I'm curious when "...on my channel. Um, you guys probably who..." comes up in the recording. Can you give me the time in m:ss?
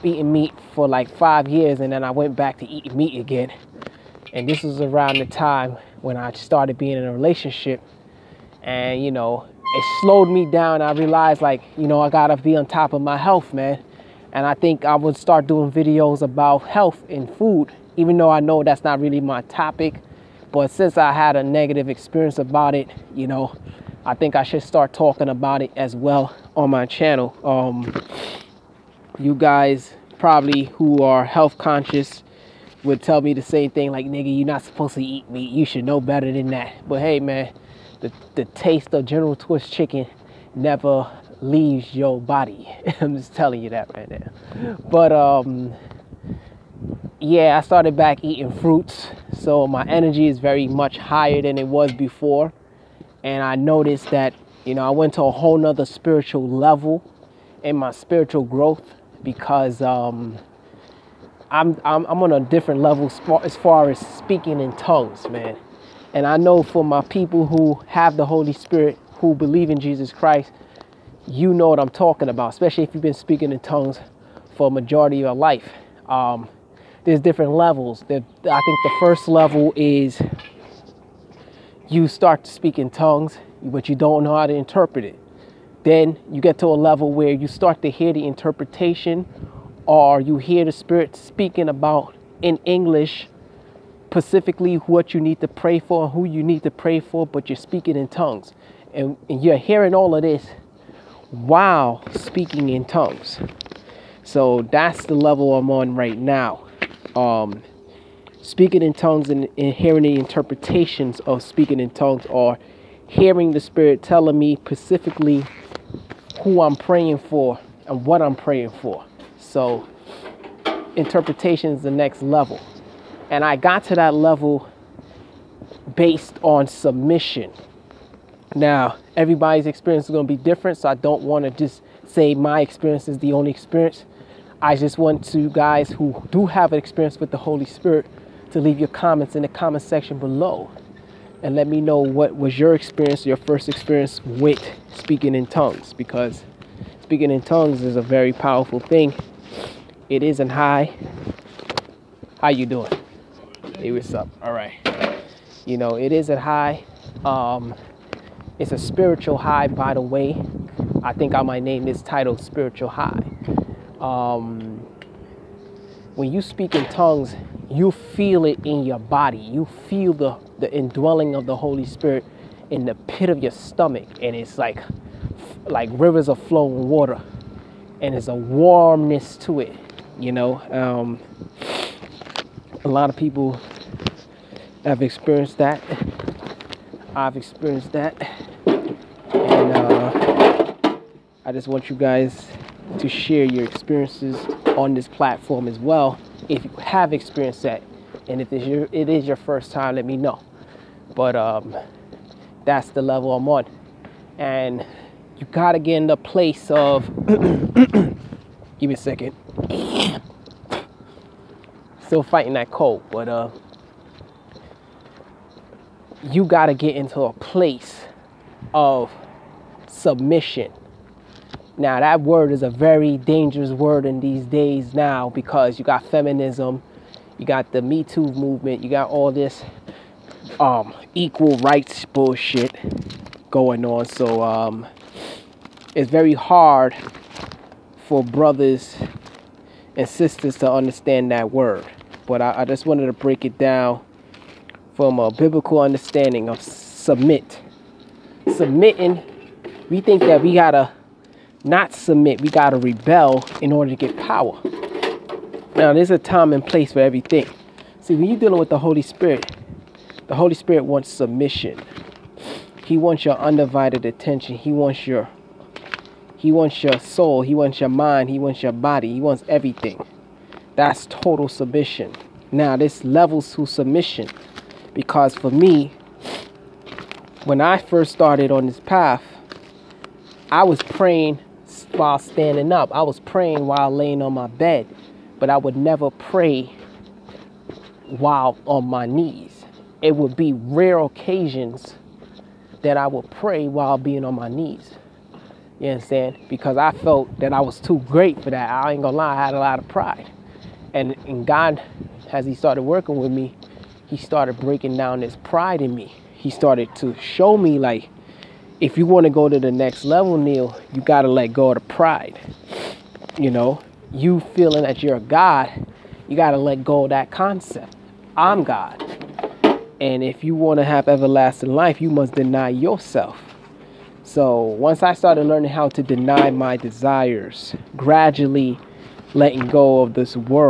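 0:26.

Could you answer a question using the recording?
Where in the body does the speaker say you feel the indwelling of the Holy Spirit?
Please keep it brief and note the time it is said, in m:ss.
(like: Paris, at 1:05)
Pit of your stomach, at 2:52.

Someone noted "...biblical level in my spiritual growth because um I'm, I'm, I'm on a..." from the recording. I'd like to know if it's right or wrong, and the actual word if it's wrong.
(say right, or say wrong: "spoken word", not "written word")
wrong: "spiritual", not "biblical".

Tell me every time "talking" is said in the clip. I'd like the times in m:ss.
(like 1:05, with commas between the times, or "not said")
0:24, 1:11.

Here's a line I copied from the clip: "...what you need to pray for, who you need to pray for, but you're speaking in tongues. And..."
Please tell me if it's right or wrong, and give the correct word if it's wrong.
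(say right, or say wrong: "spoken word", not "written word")
right.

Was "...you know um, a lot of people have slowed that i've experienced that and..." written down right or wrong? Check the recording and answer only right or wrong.
wrong.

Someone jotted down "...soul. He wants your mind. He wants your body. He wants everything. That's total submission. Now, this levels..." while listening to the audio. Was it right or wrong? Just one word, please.
right.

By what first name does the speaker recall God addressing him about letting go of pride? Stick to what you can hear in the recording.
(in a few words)
Neil.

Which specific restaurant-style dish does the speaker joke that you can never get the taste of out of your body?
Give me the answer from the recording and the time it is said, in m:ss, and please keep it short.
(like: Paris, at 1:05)
General Tso's chicken, at 0:39.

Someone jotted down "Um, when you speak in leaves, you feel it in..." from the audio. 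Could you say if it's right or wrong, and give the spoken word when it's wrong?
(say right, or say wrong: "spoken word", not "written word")
wrong: "tongues", not "leaves".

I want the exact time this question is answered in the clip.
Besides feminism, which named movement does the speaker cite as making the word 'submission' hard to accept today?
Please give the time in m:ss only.
3:47.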